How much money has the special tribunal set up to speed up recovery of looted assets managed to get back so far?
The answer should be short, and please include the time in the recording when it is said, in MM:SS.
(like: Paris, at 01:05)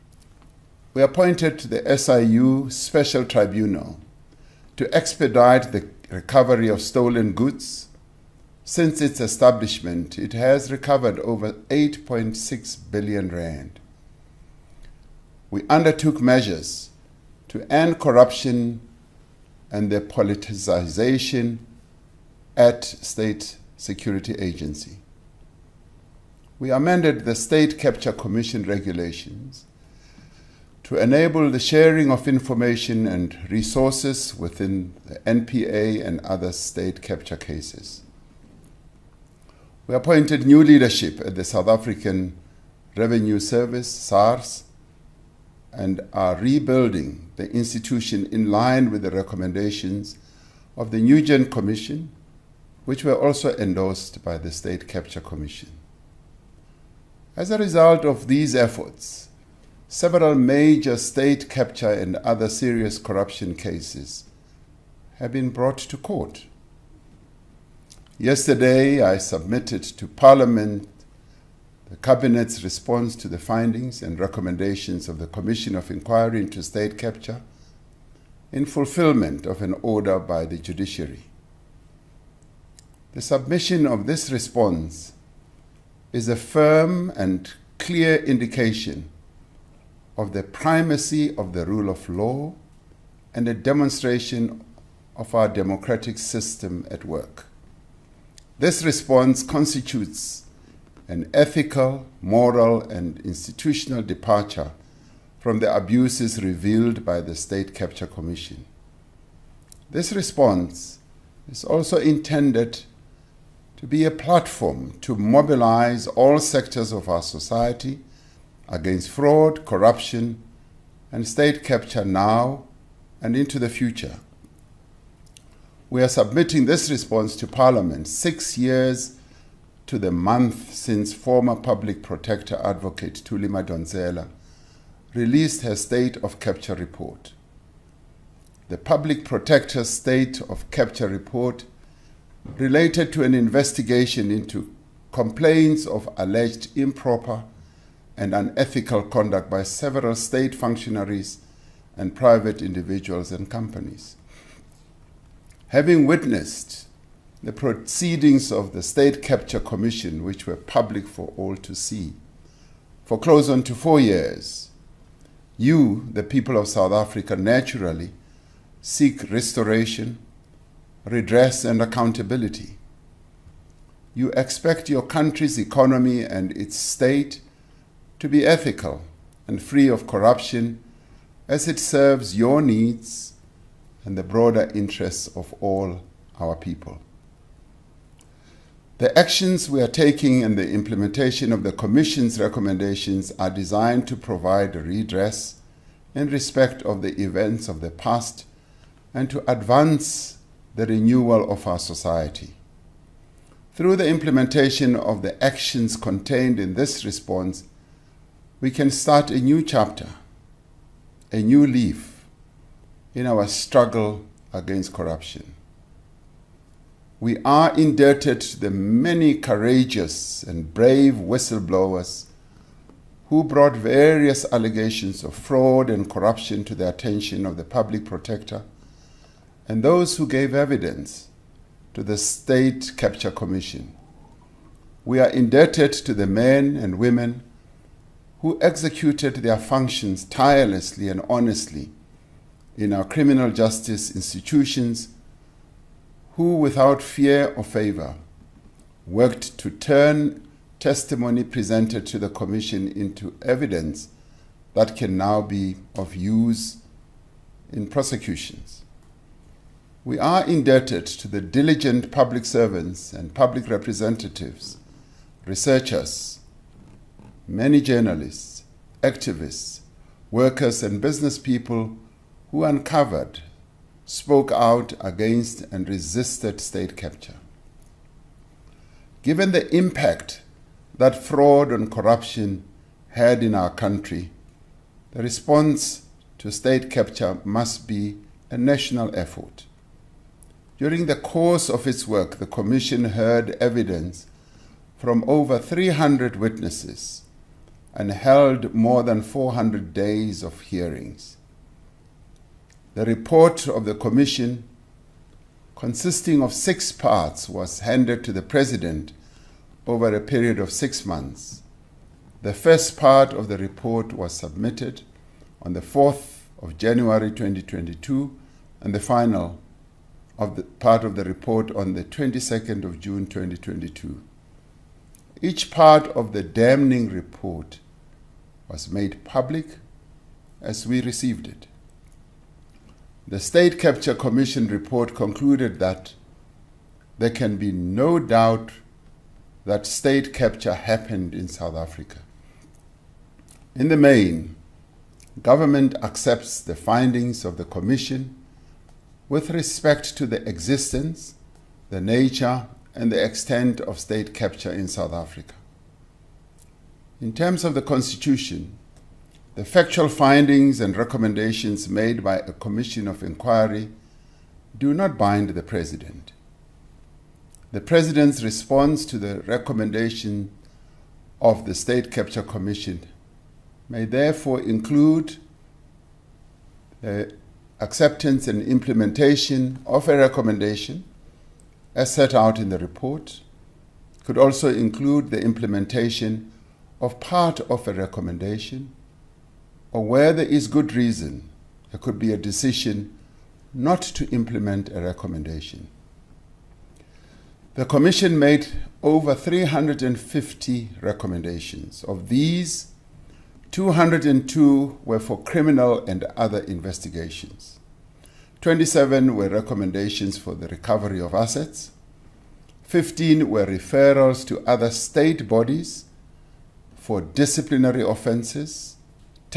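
Over R8.6 billion, at 00:11.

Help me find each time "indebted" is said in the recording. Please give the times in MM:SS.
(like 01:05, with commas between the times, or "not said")
03:37, 03:55, 04:20.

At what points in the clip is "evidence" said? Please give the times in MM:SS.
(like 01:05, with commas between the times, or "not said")
03:50, 04:13, 04:53.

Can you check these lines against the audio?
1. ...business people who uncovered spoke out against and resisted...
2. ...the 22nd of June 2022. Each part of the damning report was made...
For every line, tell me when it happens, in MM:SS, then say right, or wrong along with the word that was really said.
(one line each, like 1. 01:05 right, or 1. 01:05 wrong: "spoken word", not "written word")
1. 04:30 right
2. 05:21 right.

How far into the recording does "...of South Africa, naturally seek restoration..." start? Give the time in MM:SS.
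02:46.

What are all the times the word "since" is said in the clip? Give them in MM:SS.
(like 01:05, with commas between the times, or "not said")
00:08, 02:10.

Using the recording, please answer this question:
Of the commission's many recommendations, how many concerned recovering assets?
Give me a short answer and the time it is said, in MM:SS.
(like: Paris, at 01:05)
27, at 06:48.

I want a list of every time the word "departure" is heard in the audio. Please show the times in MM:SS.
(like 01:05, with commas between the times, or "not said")
01:43.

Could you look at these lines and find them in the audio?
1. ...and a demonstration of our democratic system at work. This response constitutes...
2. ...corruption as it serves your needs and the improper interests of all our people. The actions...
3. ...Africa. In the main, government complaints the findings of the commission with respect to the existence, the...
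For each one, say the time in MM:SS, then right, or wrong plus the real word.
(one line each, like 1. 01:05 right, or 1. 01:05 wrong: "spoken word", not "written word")
1. 01:33 right
2. 03:00 wrong: "broader", not "improper"
3. 05:41 wrong: "accepts", not "complaints".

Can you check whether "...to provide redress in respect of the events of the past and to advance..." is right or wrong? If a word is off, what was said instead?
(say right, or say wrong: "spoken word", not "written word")
right.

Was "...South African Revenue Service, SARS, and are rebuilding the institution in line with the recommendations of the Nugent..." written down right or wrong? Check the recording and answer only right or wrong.
right.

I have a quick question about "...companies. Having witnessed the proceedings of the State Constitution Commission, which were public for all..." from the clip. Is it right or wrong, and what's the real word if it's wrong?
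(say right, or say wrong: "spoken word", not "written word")
wrong: "Capture", not "Constitution".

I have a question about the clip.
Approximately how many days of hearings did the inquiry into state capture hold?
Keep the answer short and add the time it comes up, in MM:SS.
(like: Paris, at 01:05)
More than 400, at 04:58.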